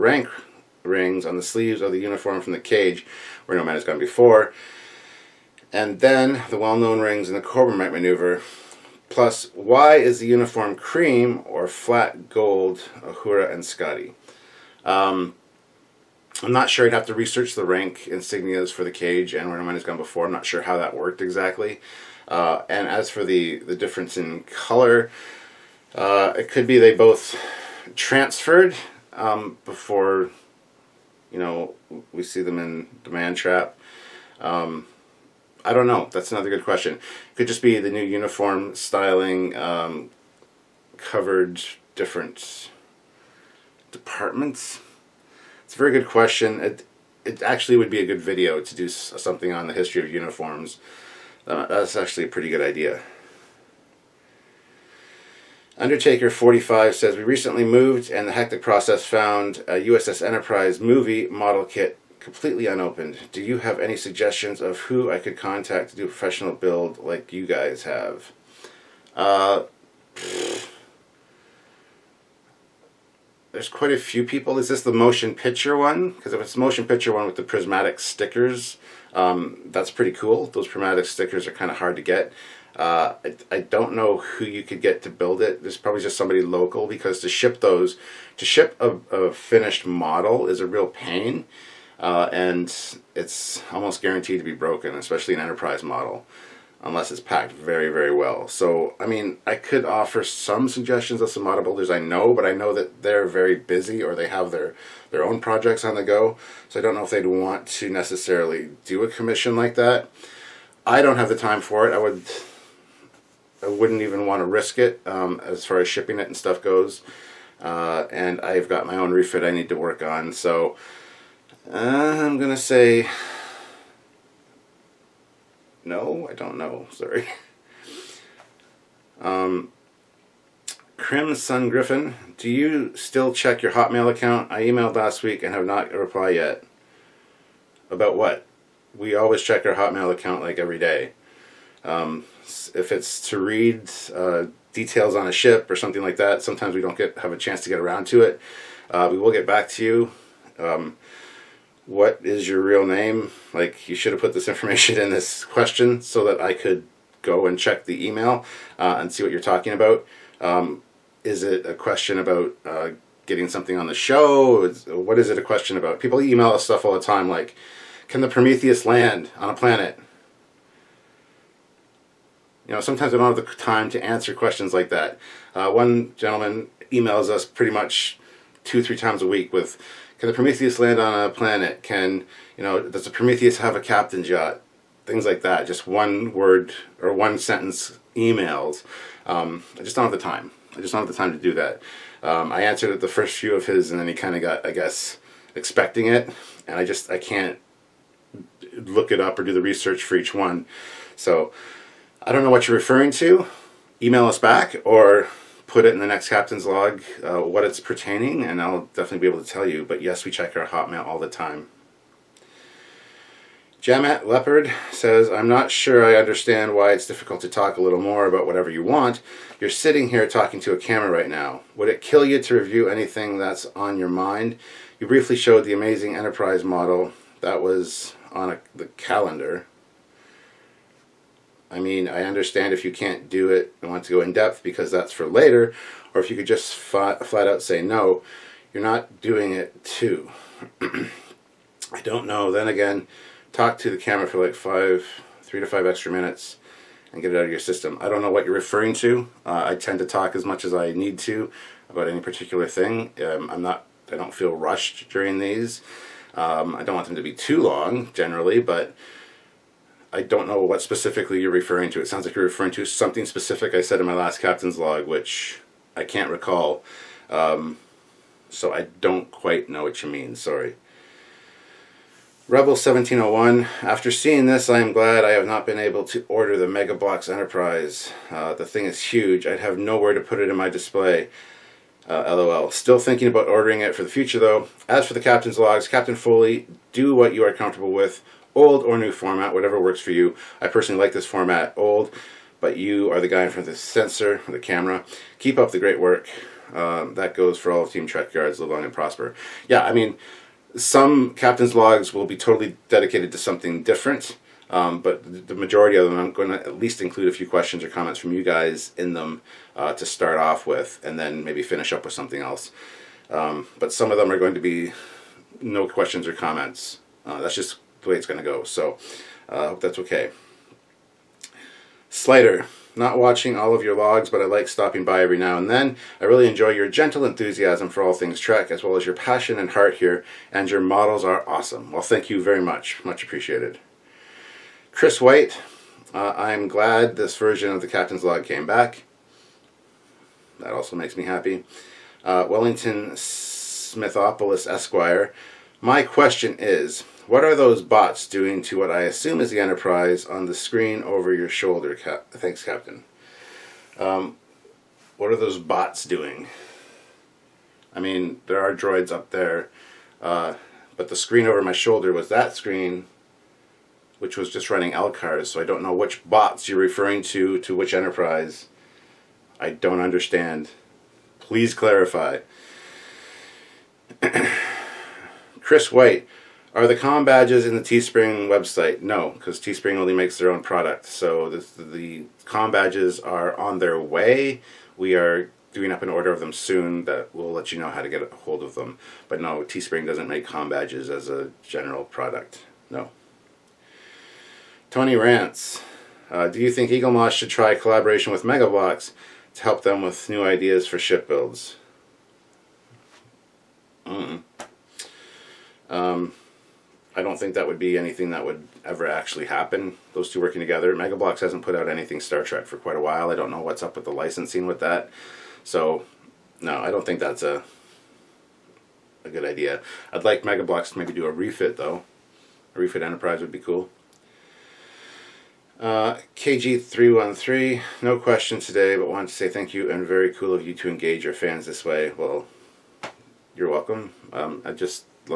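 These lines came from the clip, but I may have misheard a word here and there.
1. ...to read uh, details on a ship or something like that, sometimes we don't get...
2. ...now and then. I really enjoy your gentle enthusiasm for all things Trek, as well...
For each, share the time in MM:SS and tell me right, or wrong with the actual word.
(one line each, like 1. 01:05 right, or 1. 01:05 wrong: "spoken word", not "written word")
1. 02:23 right
2. 05:25 right.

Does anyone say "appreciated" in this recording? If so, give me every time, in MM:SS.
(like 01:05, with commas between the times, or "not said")
05:33.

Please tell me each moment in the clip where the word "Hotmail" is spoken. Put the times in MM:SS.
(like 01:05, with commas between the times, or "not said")
02:13, 02:19, 03:30.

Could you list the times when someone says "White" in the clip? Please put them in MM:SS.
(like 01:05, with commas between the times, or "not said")
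05:35, 06:15.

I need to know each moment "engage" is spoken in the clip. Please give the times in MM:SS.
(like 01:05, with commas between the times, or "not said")
07:10.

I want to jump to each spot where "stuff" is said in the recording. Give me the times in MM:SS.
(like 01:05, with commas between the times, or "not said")
01:56, 02:46.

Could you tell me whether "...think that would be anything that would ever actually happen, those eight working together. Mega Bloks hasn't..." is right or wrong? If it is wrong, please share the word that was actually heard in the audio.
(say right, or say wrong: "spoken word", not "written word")
wrong: "two", not "eight".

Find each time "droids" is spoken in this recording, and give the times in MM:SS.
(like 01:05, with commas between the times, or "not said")
05:58.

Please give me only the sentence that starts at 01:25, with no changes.
There's probably just somebody local because to ship those, to ship a, a finished model is a real pain.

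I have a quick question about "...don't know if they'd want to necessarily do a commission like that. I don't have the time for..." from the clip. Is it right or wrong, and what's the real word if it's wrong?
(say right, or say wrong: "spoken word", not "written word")
right.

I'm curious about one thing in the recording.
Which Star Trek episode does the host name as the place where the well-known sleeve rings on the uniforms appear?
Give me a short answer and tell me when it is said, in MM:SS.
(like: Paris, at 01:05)
The Corbomite Maneuver, at 00:07.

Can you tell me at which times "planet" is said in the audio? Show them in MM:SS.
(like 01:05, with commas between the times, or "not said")
02:49, 03:01.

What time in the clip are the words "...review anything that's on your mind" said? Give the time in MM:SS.
03:42.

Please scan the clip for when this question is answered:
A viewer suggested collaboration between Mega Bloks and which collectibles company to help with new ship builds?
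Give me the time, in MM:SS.
06:36.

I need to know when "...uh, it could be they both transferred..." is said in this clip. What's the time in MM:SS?
00:25.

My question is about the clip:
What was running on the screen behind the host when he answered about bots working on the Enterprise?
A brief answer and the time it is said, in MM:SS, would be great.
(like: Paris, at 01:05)
Alcars, at 06:04.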